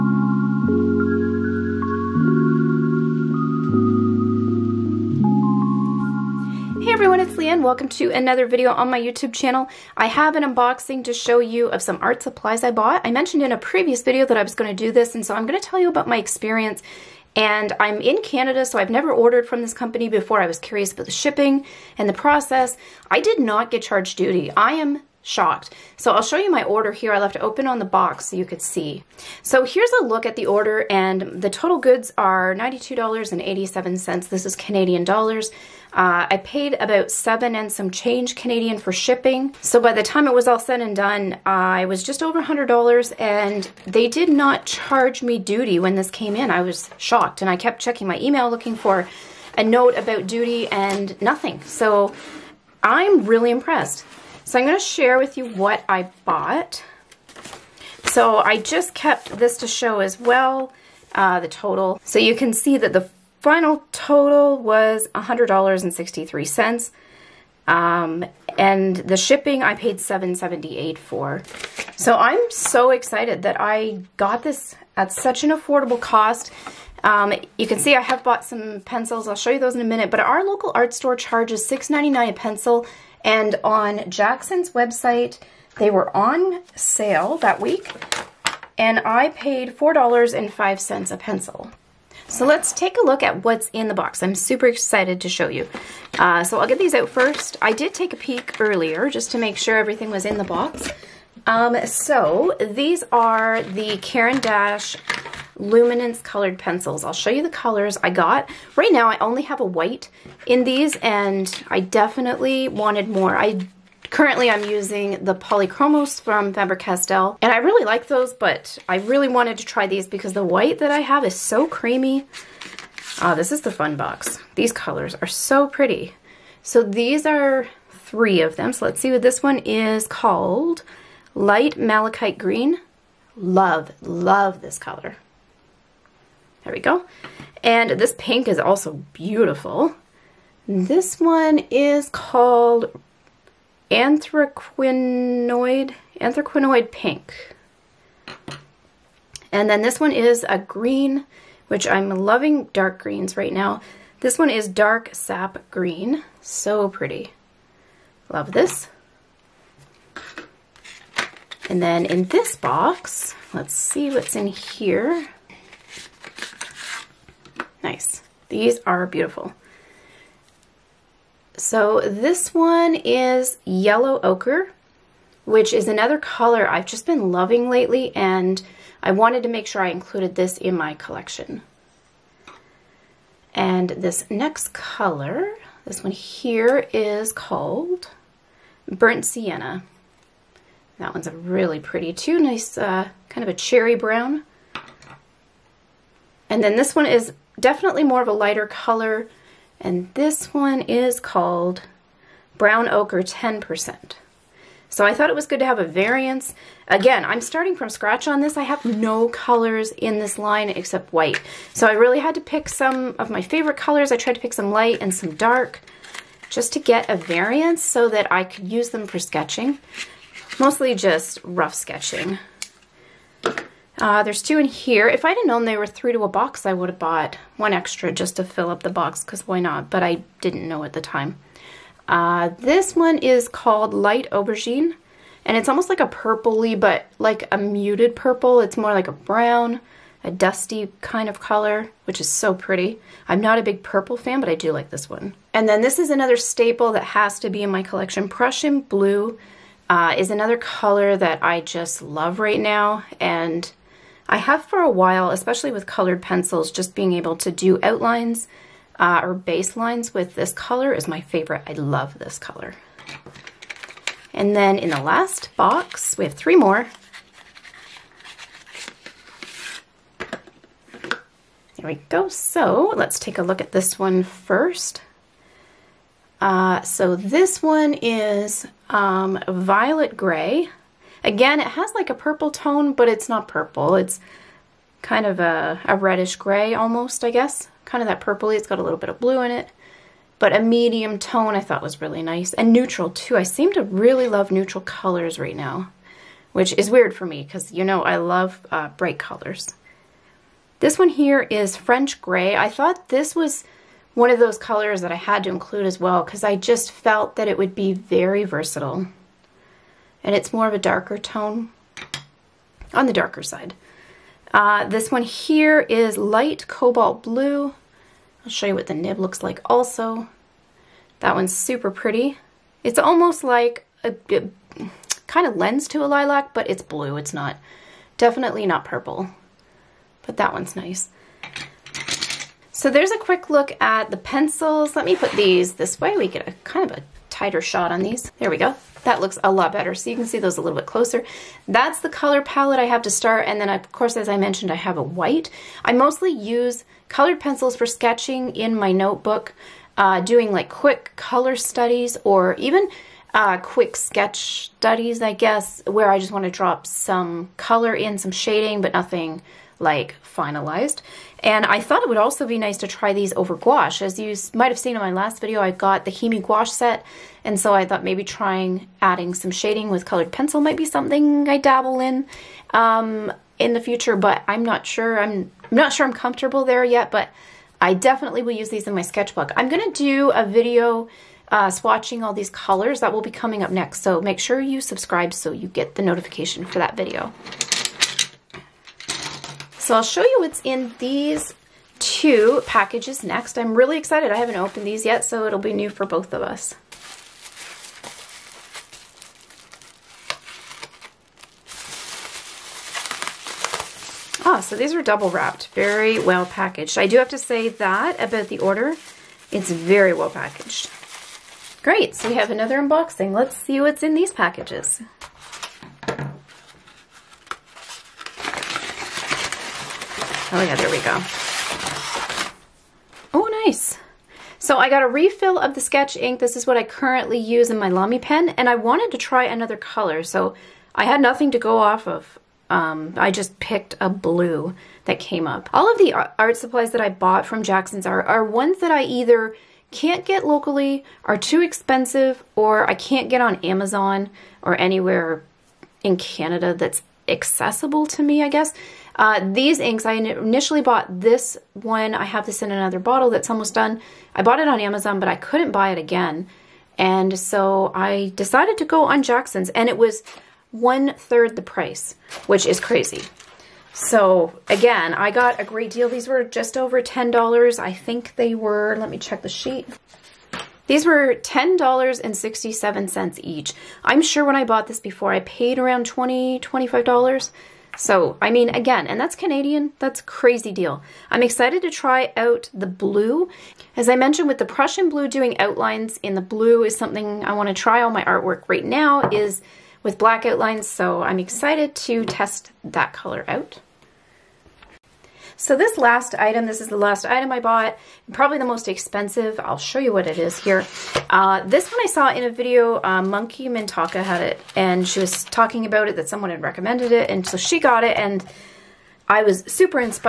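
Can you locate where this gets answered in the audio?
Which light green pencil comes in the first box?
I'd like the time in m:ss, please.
2:11.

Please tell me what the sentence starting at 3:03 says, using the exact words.
And this next color, this one here is called Burnt Sienna.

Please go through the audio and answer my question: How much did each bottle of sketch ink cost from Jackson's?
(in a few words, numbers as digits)
$10.67.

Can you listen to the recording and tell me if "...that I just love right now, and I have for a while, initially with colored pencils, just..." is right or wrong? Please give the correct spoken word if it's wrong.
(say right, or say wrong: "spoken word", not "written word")
wrong: "especially", not "initially".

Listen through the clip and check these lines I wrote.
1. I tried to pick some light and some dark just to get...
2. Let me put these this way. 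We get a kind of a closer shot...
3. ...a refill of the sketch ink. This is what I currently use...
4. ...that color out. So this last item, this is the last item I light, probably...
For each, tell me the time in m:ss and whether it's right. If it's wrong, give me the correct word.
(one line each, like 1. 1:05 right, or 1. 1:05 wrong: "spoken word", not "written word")
1. 3:34 right
2. 5:34 wrong: "tighter", not "closer"
3. 7:05 right
4. 8:12 wrong: "bought", not "light".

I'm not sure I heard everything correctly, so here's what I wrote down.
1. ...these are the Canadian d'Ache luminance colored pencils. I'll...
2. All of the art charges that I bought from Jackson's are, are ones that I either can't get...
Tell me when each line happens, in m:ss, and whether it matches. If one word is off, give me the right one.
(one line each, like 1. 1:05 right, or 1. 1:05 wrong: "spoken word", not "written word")
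1. 1:42 wrong: "Caran", not "Canadian"
2. 7:15 wrong: "supplies", not "charges".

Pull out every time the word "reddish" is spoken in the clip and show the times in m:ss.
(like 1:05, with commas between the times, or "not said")
4:45.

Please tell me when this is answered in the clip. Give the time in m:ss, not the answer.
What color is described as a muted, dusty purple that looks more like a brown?
3:53.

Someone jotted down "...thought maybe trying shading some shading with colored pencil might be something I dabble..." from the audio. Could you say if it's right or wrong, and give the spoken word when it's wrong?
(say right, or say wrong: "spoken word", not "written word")
wrong: "adding", not "shading".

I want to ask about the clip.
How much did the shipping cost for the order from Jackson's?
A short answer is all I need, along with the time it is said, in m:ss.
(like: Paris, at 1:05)
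$7.78, at 1:09.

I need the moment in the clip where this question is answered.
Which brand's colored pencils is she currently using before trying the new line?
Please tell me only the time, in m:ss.
1:56.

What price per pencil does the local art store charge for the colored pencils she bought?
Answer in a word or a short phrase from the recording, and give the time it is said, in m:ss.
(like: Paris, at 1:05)
$6.99, at 1:21.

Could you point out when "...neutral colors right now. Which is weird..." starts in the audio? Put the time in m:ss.
4:54.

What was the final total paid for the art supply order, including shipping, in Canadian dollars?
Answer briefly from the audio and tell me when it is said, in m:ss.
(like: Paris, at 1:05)
$100.63, at 1:05.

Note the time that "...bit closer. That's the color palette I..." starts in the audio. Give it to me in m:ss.
5:40.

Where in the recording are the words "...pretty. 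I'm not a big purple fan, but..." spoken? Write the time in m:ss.
4:02.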